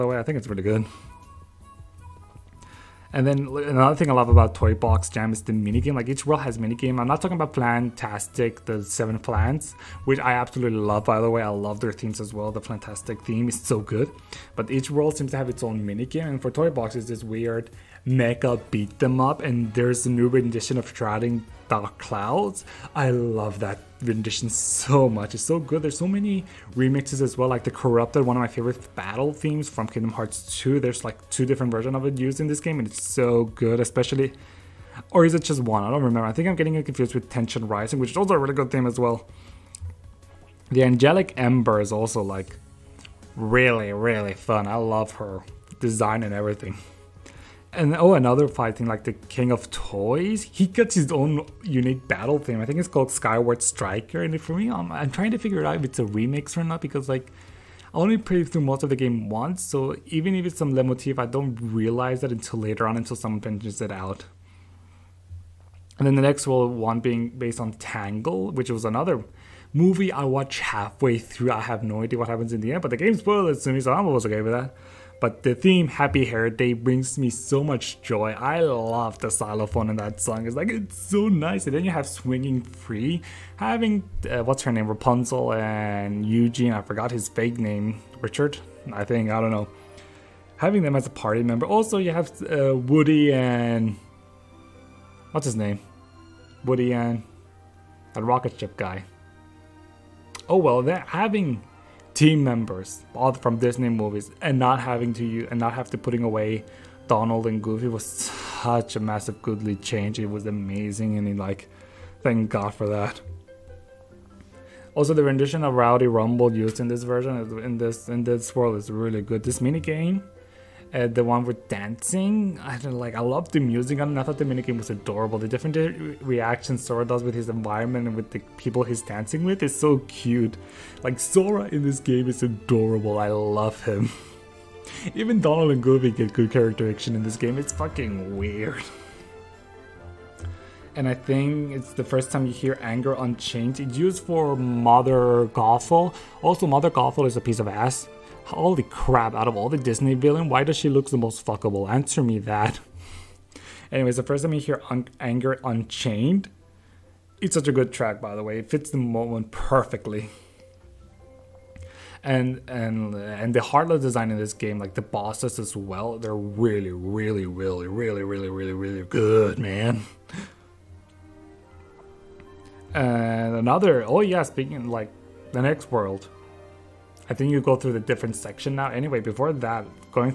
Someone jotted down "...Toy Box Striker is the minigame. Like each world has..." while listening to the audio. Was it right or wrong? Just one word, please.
wrong.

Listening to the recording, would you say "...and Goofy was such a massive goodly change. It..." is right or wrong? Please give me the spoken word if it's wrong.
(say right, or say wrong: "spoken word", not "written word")
right.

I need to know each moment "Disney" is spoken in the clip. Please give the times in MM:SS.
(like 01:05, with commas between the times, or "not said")
01:43, 02:29.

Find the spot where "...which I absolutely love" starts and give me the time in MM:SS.
00:10.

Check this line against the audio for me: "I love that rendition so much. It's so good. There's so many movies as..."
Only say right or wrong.
wrong.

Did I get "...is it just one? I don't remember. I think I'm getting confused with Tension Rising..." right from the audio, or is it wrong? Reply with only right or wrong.
right.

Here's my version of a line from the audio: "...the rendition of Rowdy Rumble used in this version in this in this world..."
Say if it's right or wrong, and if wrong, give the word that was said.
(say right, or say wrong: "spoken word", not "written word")
right.